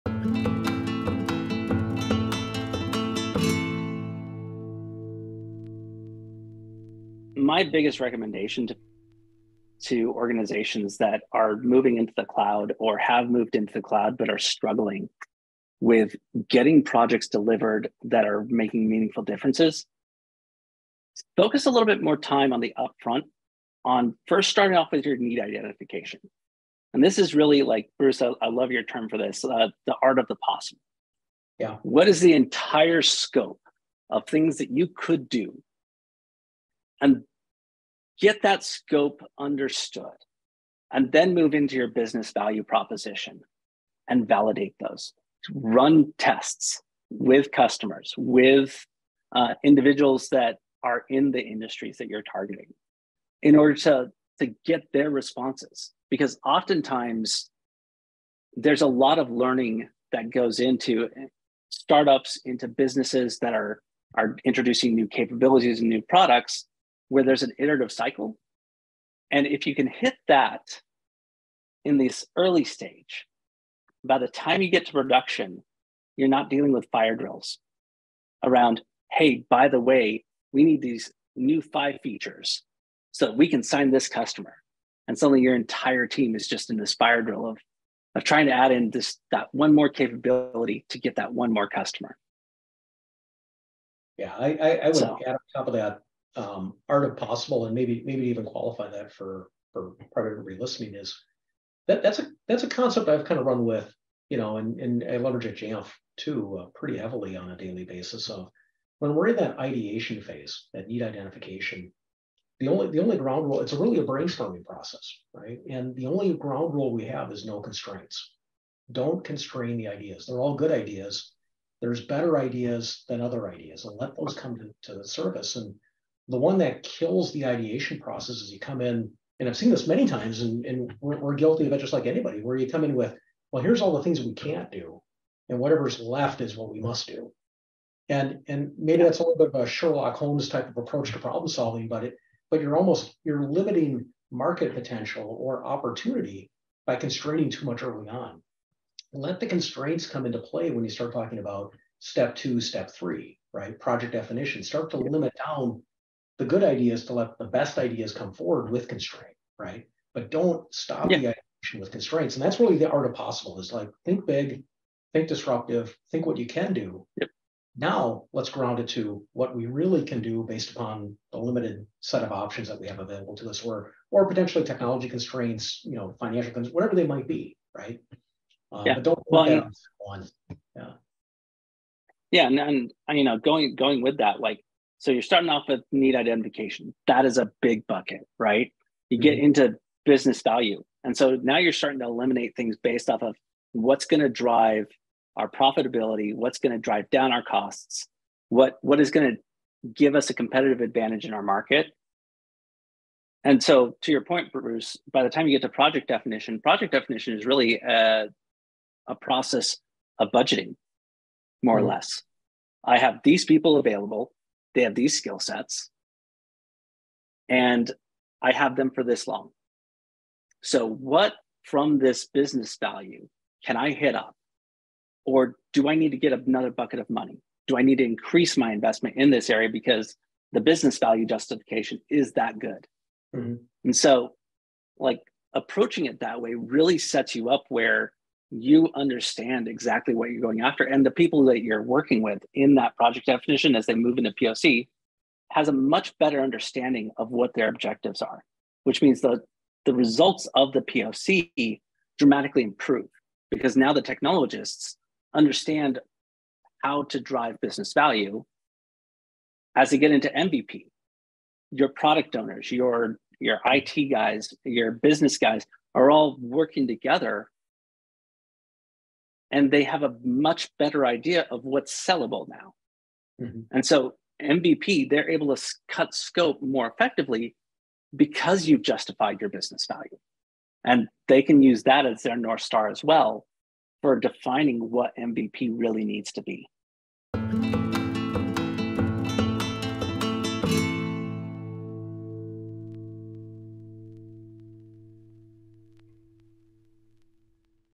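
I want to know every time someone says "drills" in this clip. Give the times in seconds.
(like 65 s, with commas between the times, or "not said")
77 s, 87 s.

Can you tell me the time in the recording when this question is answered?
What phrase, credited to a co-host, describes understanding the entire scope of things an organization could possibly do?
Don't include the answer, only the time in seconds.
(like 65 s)
29 s.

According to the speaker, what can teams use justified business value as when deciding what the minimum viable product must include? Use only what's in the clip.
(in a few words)
North Star.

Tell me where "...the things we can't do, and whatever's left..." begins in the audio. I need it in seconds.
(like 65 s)
133 s.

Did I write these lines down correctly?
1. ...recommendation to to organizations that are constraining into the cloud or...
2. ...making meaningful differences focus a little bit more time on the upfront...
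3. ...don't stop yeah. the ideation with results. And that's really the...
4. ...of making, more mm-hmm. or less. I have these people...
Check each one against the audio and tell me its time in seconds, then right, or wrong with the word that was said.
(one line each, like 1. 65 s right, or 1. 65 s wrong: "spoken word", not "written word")
1. 7 s wrong: "moving", not "constraining"
2. 18 s right
3. 160 s wrong: "constraints", not "results"
4. 210 s wrong: "budgeting", not "making".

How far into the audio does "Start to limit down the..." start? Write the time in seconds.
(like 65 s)
154 s.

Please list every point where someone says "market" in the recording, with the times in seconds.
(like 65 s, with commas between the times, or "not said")
144 s, 201 s.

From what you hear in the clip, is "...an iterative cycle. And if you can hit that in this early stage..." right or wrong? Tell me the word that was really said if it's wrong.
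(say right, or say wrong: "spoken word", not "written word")
right.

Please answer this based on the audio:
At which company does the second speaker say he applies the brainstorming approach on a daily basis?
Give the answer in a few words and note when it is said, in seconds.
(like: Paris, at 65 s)
Jamf, at 105 s.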